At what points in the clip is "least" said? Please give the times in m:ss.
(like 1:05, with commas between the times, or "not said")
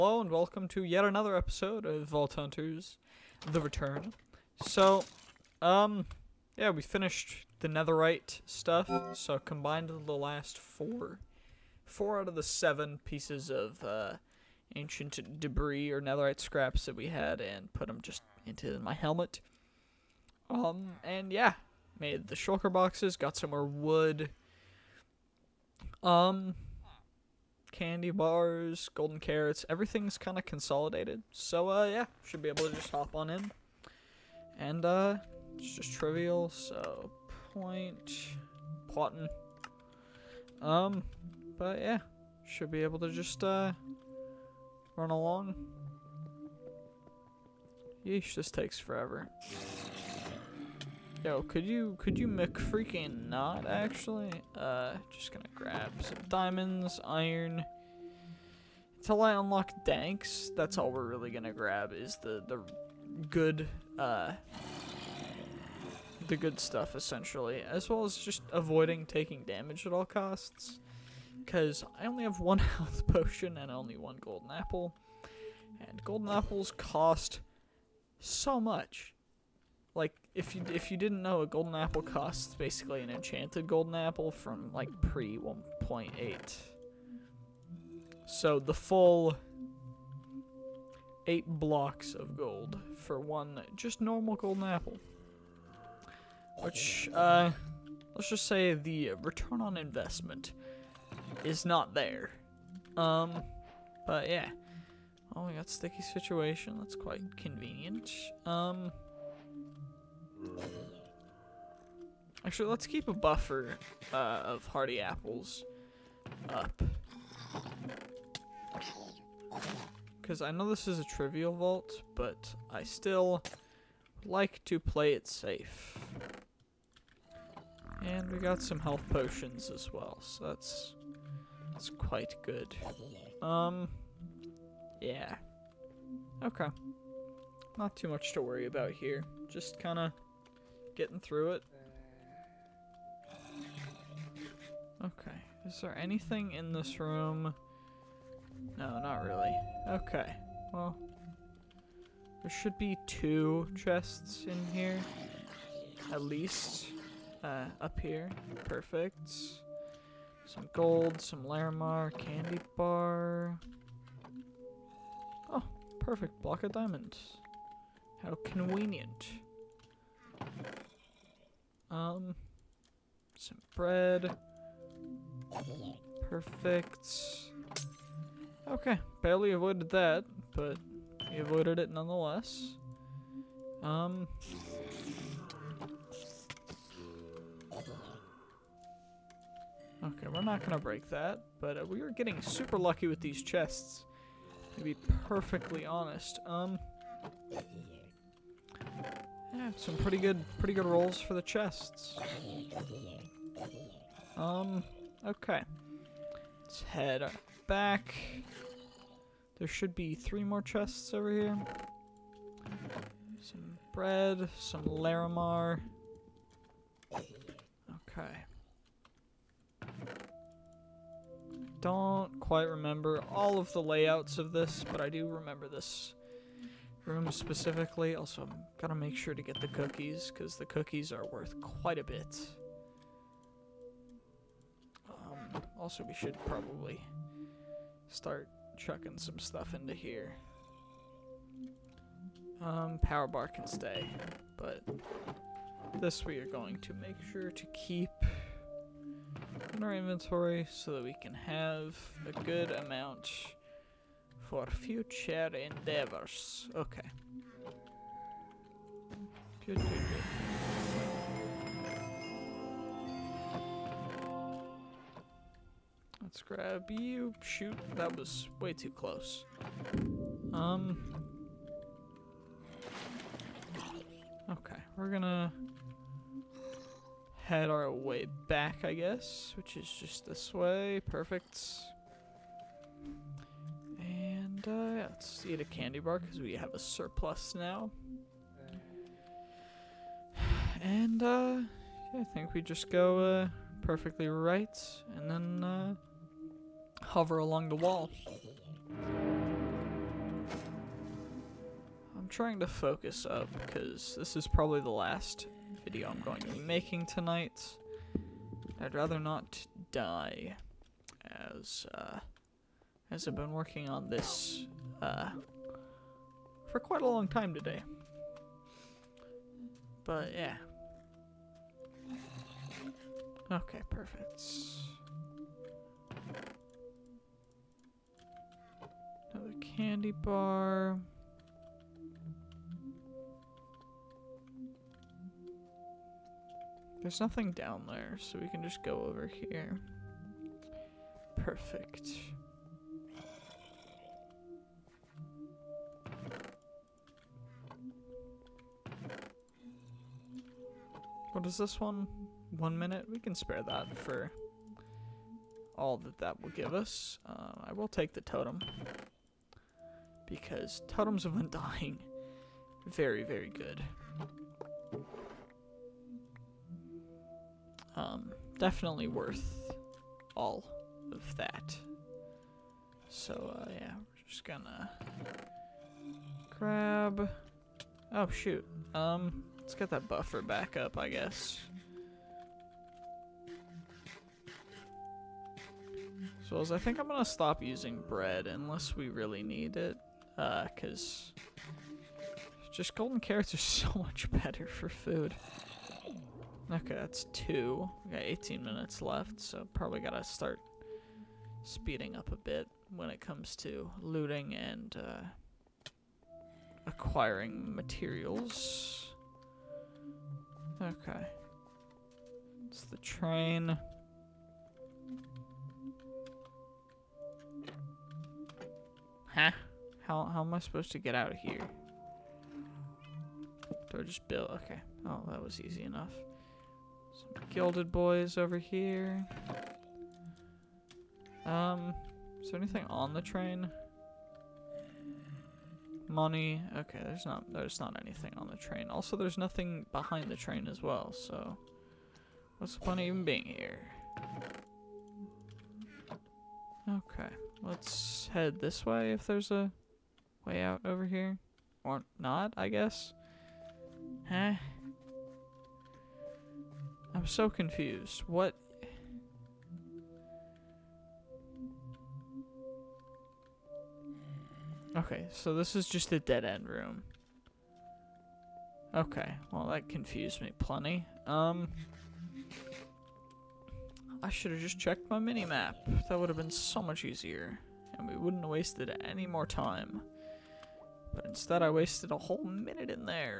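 2:36.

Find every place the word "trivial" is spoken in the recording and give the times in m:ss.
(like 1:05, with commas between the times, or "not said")
0:35, 2:01.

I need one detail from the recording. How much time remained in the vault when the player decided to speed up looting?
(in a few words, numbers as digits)
18 minutes.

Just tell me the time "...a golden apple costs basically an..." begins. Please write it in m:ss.
1:21.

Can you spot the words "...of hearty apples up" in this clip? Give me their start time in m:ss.
1:54.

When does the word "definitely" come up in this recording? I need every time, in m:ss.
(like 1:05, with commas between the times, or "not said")
6:08.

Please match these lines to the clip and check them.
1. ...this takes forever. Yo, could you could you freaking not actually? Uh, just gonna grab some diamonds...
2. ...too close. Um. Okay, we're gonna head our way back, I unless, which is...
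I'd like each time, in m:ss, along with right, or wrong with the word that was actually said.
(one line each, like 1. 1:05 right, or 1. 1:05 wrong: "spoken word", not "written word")
1. 0:48 right
2. 4:28 wrong: "guess", not "unless".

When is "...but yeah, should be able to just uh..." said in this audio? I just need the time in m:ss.
0:41.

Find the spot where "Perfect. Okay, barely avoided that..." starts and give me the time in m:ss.
2:56.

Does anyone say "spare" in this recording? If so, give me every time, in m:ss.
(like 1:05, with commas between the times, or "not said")
5:53.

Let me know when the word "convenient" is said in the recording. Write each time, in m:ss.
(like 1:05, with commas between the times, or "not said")
1:47, 2:48.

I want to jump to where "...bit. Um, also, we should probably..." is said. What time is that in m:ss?
3:52.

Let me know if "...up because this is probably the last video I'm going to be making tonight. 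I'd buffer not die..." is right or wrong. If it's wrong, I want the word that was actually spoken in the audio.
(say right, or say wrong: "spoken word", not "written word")
wrong: "rather", not "buffer".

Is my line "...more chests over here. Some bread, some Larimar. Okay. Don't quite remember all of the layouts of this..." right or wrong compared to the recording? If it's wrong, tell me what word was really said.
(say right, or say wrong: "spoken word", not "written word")
right.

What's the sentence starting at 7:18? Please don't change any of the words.
Also, there's nothing behind the train as well, so...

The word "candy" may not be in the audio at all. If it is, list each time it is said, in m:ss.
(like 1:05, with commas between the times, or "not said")
0:27, 2:42, 4:45, 5:29.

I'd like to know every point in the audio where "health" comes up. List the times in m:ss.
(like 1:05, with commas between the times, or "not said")
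1:12, 2:08.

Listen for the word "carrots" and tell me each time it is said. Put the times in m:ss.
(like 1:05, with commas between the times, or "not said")
0:29, 6:33.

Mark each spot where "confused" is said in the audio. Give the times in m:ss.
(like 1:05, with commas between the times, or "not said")
7:37, 7:49.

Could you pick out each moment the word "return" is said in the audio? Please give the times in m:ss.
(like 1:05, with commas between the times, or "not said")
0:03, 1:39.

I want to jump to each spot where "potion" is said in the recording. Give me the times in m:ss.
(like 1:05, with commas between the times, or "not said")
1:13, 2:09.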